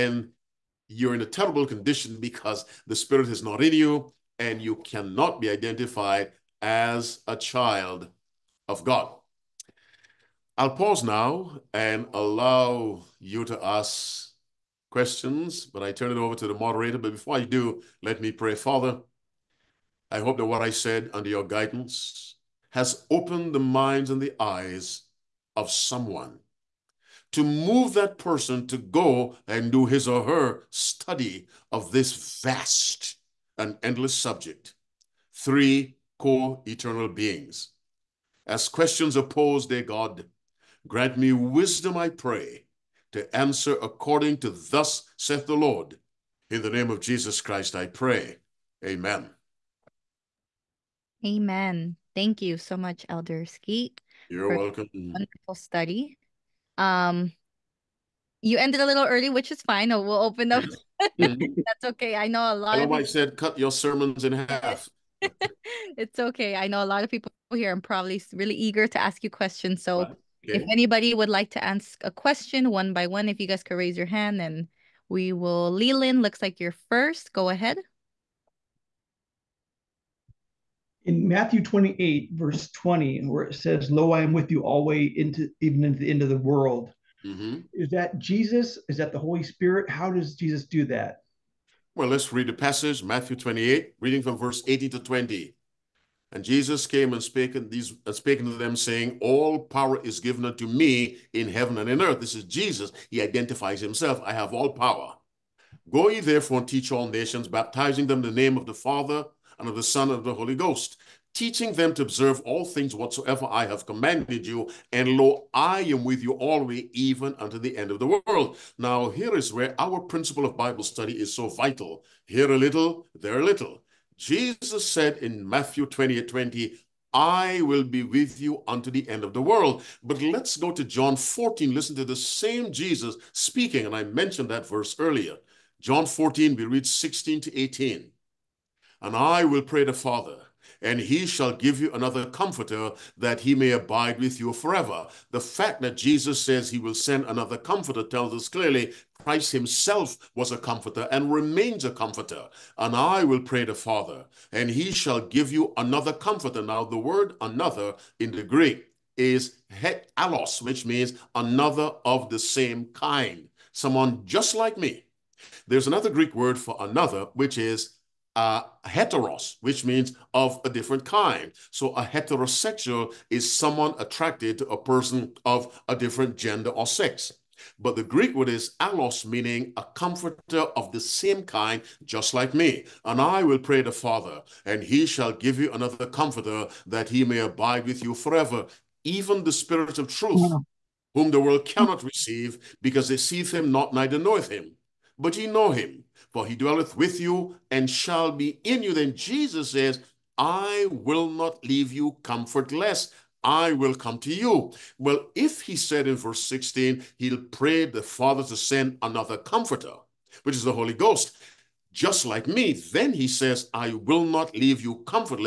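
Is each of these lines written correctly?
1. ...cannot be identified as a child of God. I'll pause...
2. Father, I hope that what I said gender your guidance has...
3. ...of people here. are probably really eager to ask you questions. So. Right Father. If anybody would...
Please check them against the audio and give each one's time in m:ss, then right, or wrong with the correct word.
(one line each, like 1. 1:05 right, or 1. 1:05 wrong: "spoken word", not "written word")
1. 0:04 right
2. 0:18 wrong: "under", not "gender"
3. 1:07 wrong: "Okay", not "Father".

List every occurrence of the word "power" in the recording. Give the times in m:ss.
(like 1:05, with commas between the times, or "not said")
1:39, 1:44.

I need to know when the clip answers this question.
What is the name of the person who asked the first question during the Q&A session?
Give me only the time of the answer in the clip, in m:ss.
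1:15.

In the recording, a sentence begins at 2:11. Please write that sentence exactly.
Listen to the same Jesus speaking, and I mentioned that verse earlier.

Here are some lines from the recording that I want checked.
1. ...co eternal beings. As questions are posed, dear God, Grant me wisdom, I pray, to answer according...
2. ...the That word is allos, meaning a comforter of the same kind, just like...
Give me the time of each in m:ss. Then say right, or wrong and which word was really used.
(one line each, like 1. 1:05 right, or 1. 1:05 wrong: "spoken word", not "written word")
1. 0:36 right
2. 2:57 wrong: "Greek", not "That".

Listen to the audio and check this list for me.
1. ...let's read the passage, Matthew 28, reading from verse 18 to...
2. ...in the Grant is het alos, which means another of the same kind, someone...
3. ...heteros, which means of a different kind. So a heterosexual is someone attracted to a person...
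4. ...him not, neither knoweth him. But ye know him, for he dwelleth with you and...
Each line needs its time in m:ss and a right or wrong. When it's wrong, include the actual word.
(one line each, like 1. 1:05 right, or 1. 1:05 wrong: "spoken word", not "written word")
1. 1:32 right
2. 2:38 wrong: "Greek", not "Grant"
3. 2:48 right
4. 3:13 right.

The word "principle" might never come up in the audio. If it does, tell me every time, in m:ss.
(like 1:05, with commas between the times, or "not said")
2:00.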